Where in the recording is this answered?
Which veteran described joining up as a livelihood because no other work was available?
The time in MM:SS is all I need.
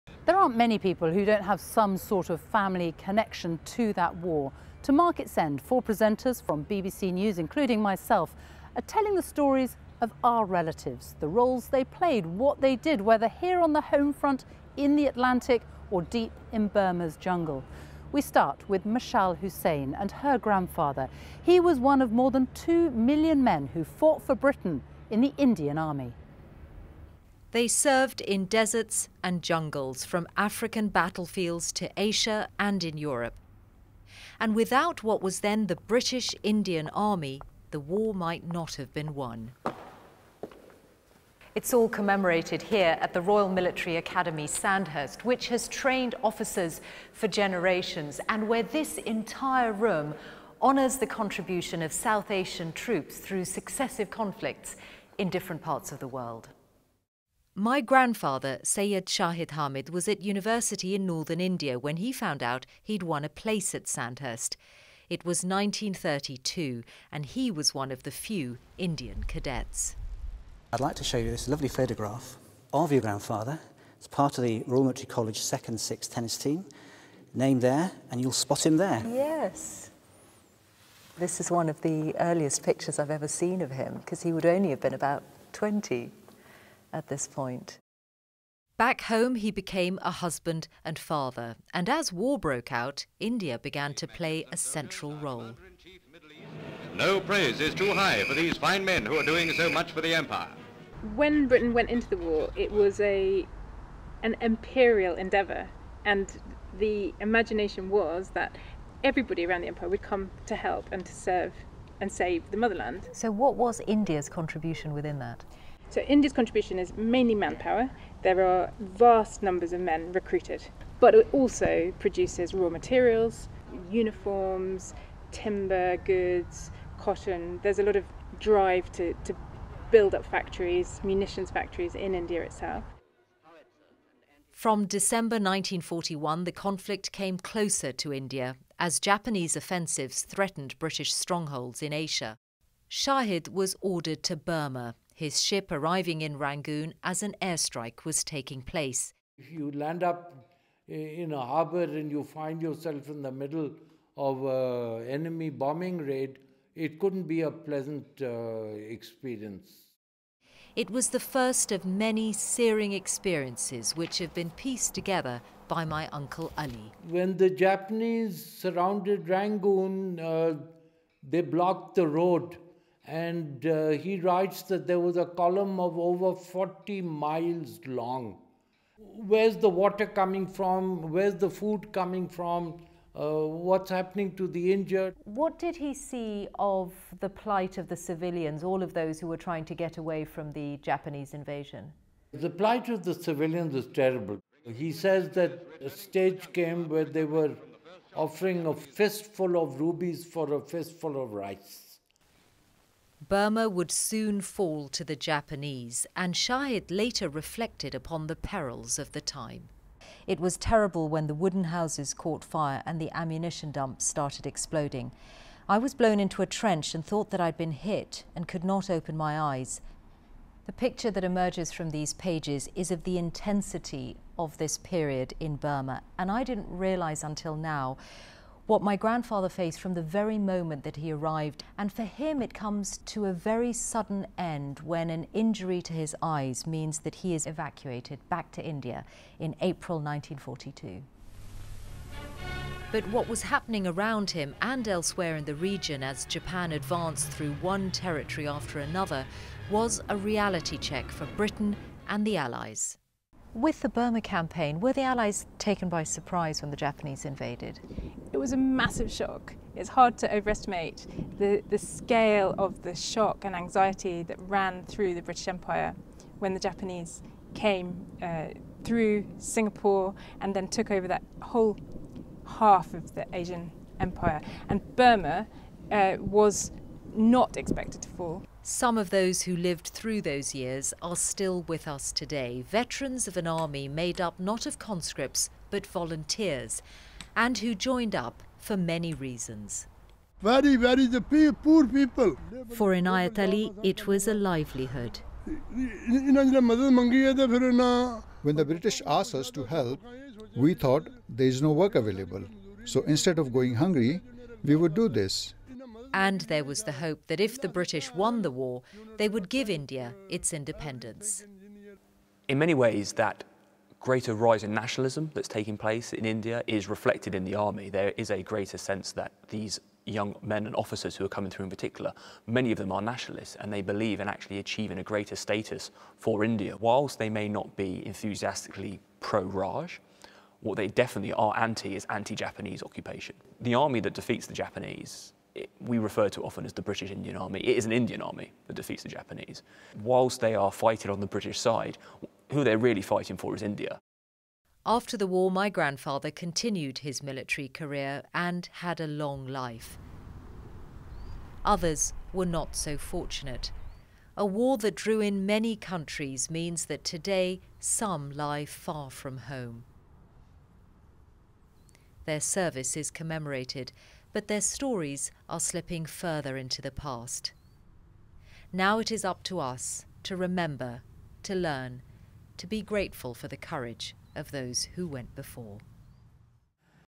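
04:52.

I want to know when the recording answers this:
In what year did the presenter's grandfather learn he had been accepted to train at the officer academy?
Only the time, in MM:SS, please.
01:05.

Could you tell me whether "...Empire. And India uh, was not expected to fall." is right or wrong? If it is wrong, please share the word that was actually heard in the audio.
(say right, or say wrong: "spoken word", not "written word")
wrong: "Burma", not "India".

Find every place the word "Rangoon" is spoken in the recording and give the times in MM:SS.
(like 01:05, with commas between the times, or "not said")
02:26, 02:49.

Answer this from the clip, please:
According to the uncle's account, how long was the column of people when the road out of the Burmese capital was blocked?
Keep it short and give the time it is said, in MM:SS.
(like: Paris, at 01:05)
Over 40 miles, at 02:55.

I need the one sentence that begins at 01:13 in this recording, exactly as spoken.
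It's part of the Royal Military College 2nd 6th tennis team.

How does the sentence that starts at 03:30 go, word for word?
It was terrible when the wooden houses caught fire and the ammunition dumps started exploding.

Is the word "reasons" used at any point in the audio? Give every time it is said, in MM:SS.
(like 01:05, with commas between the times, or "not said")
04:49.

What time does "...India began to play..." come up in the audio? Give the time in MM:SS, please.
01:33.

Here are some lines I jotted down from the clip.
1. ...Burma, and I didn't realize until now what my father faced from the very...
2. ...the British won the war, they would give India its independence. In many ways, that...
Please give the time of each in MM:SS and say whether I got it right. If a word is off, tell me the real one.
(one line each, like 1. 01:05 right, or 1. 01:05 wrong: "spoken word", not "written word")
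1. 03:45 wrong: "grandfather", not "father"
2. 05:07 right.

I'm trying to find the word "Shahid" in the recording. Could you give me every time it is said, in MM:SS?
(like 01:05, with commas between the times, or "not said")
00:59, 02:22, 03:26.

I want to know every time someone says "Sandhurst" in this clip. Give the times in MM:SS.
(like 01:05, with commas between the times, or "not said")
00:44, 01:03.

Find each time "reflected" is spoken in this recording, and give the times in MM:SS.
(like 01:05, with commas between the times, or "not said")
03:27, 05:16.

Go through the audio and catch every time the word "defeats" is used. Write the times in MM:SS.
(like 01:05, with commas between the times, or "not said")
05:34, 05:38.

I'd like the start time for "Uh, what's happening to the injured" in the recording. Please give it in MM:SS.
03:03.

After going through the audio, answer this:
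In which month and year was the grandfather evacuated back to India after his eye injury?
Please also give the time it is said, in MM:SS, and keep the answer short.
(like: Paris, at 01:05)
April 1942, at 03:59.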